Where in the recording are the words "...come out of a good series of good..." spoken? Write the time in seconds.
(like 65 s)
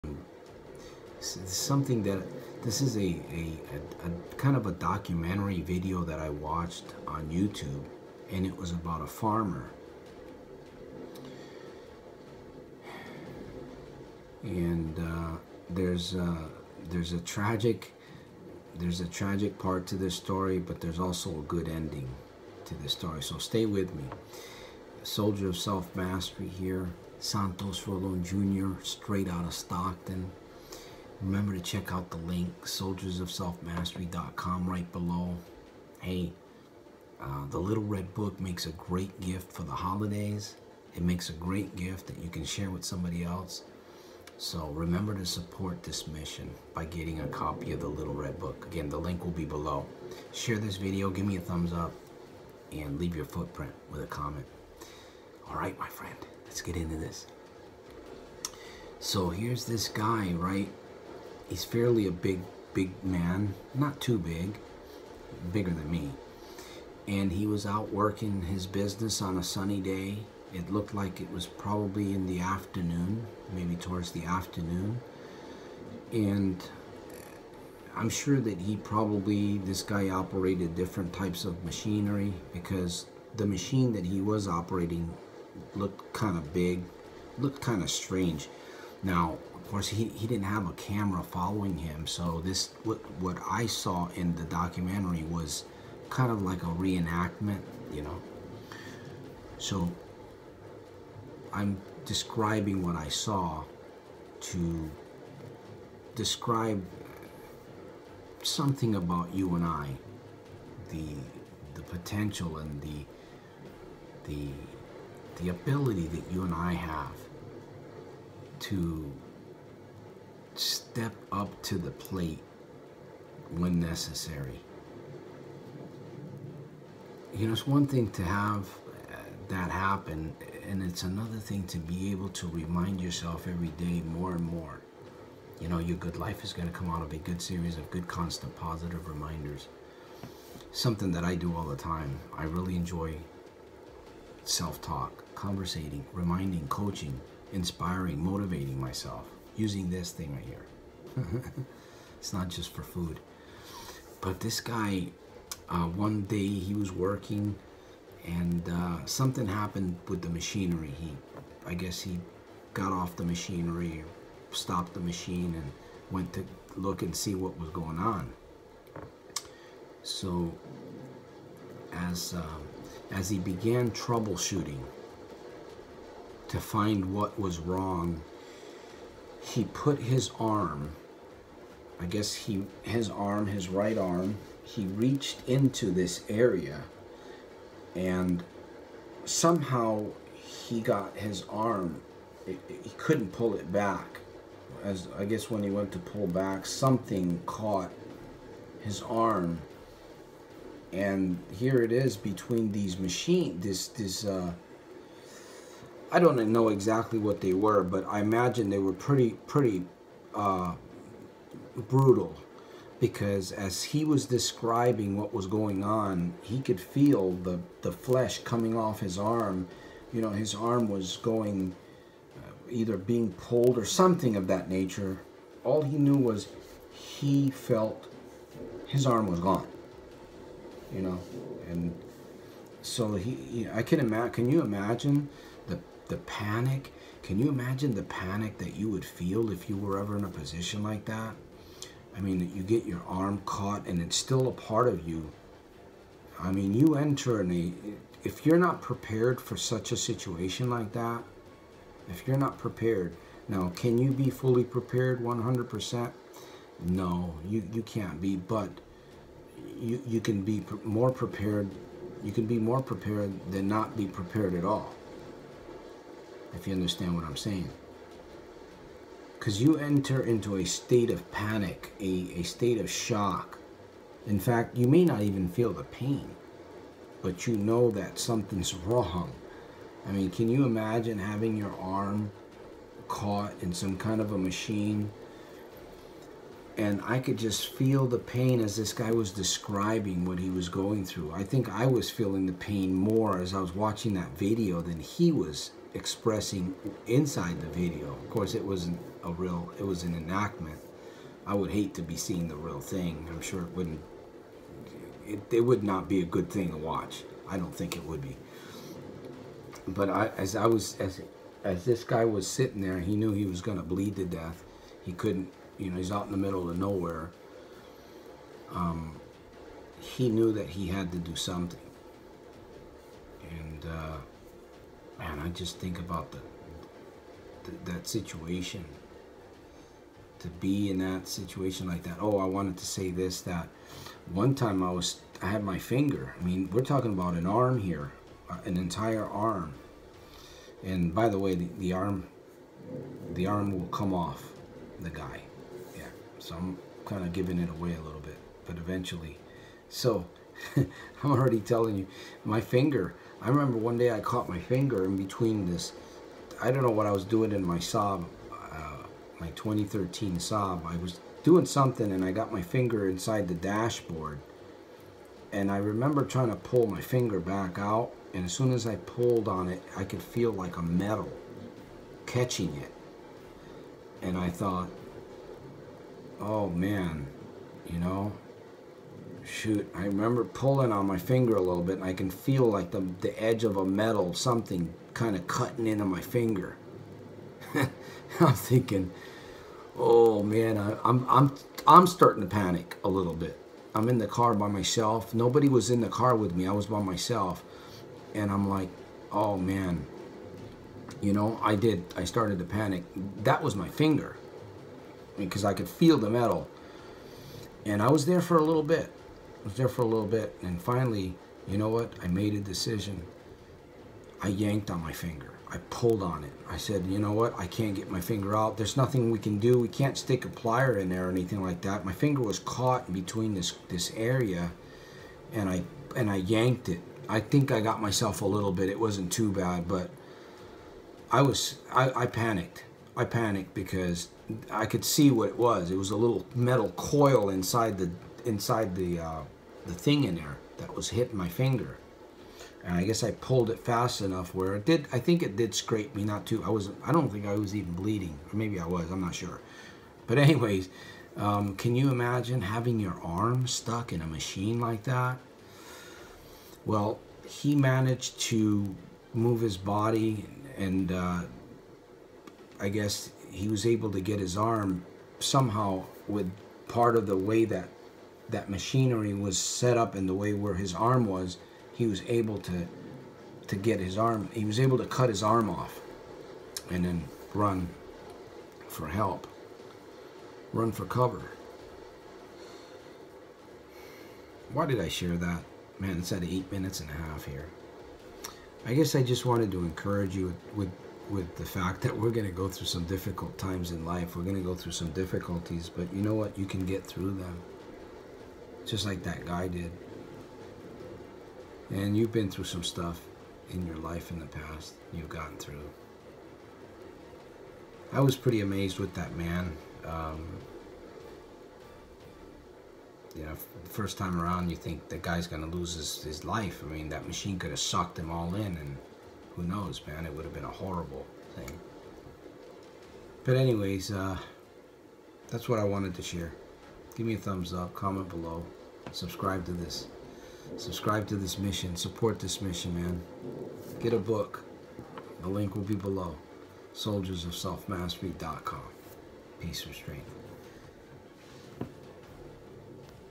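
136 s.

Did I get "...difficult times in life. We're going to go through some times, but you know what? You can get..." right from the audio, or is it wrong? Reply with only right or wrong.
wrong.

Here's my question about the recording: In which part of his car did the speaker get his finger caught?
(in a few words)
The dashboard.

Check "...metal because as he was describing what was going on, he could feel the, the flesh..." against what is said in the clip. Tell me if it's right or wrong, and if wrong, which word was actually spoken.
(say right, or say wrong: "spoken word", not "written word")
wrong: "brutal", not "metal".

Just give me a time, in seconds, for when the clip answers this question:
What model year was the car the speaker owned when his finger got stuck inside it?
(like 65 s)
359 s.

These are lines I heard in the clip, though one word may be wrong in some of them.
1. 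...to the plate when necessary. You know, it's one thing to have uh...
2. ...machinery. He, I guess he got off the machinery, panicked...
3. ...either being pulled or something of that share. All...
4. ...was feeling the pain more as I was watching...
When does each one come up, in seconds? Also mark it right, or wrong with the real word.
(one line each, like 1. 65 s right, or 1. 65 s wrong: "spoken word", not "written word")
1. 121 s right
2. 160 s wrong: "stopped", not "panicked"
3. 222 s wrong: "nature", not "share"
4. 291 s right.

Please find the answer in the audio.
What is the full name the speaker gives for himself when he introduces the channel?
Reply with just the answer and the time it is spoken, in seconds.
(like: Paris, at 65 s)
Santos Rolon Jr., at 27 s.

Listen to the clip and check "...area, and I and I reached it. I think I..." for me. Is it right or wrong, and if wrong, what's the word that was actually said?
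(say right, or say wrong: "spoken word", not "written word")
wrong: "yanked", not "reached".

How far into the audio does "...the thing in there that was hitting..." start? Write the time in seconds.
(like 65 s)
439 s.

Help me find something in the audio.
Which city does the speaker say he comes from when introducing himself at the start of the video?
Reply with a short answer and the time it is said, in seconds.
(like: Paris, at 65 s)
Stockton, at 29 s.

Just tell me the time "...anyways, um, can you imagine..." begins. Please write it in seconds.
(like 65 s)
450 s.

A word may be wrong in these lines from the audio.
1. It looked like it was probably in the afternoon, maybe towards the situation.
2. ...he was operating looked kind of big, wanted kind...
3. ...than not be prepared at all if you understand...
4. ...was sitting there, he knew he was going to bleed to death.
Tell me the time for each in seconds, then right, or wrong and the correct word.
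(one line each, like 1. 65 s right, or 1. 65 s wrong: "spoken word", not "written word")
1. 70 s wrong: "afternoon", not "situation"
2. 84 s wrong: "looked", not "wanted"
3. 263 s right
4. 312 s right.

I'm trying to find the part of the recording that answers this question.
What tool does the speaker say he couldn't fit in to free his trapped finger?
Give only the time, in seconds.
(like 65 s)
420 s.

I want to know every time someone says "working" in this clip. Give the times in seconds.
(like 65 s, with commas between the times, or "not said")
67 s, 156 s.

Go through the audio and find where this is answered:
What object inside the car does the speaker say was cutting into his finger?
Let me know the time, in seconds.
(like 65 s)
436 s.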